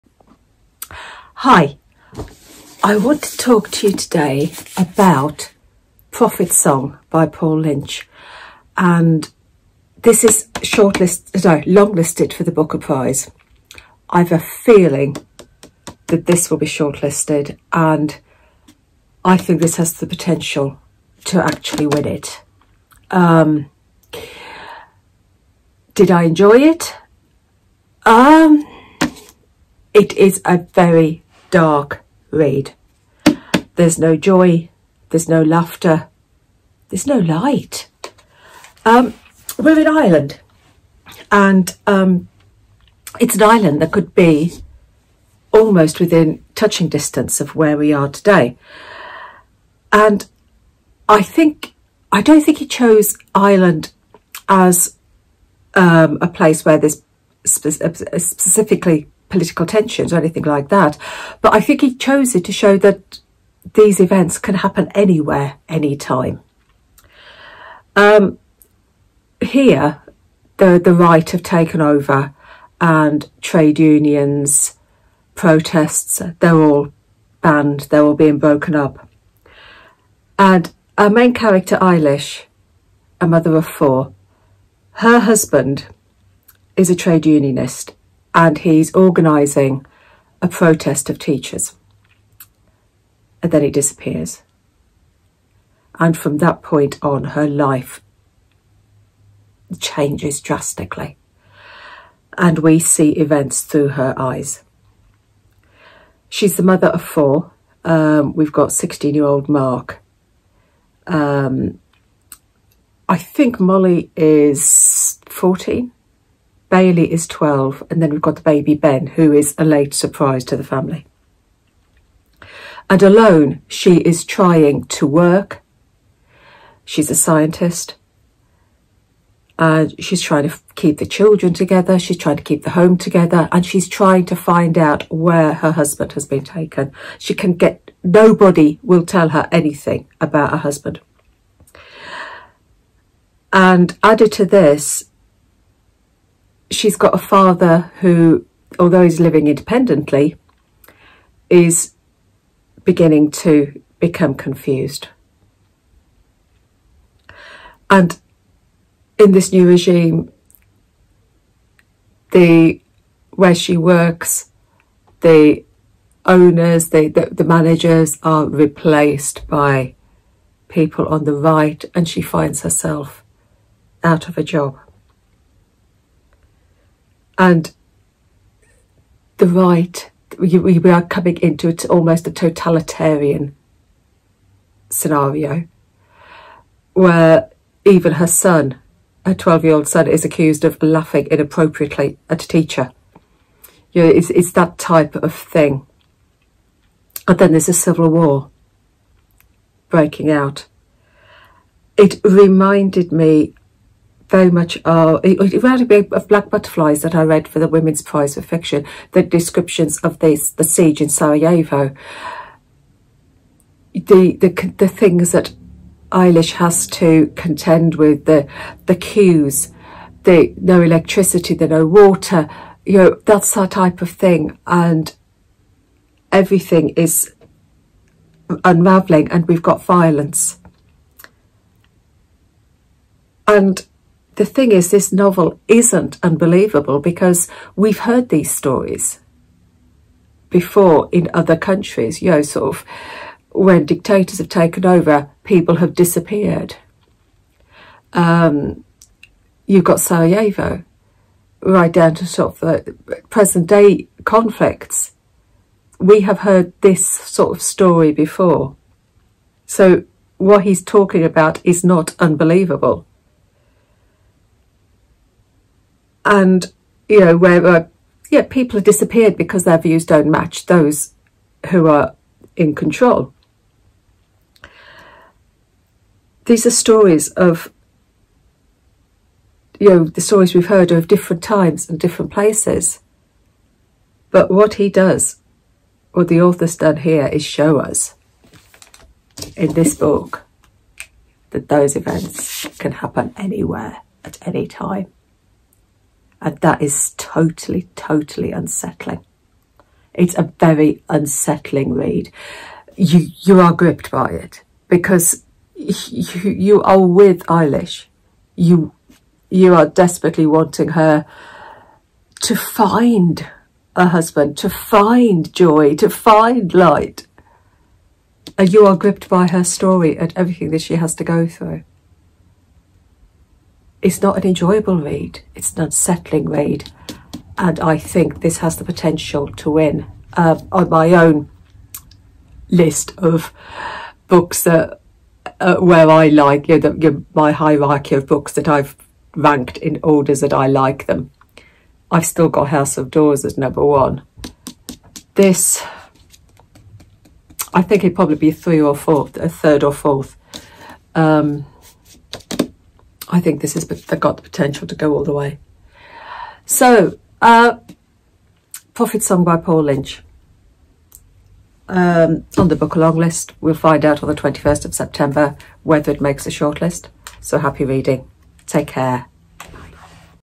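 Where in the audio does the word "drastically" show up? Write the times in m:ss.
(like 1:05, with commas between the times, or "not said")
1:40.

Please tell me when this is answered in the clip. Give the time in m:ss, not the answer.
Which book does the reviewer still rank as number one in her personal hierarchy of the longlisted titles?
5:42.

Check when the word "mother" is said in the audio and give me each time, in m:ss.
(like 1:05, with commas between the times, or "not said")
1:23, 1:46.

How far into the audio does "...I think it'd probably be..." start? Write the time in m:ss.
5:47.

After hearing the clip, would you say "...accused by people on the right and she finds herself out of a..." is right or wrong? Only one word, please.
wrong.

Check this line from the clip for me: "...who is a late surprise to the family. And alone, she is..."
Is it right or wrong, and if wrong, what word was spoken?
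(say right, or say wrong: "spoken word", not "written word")
right.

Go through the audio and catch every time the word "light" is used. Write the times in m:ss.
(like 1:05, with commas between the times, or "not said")
0:37, 5:16.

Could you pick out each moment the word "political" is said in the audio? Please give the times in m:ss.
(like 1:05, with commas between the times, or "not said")
0:59.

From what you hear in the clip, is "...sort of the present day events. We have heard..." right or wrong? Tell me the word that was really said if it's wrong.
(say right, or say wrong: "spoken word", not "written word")
wrong: "conflicts", not "events".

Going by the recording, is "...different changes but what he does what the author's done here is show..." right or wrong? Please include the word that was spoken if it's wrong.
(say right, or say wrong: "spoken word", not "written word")
wrong: "places", not "changes".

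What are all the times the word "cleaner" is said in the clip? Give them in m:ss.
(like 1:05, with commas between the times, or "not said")
not said.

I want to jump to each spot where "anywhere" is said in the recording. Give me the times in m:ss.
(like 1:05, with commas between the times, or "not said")
1:04, 4:53.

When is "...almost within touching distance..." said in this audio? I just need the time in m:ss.
0:45.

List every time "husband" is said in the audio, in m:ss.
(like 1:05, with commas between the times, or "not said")
1:25, 2:15, 2:20, 5:14.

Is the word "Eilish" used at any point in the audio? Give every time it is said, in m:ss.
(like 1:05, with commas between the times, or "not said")
1:21, 3:36, 5:07.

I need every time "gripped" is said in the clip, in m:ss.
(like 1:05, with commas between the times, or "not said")
5:03, 5:18.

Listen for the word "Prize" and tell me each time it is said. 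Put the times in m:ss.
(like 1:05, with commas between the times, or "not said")
0:12, 3:28.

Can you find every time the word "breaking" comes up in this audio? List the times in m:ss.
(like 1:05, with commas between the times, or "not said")
3:19.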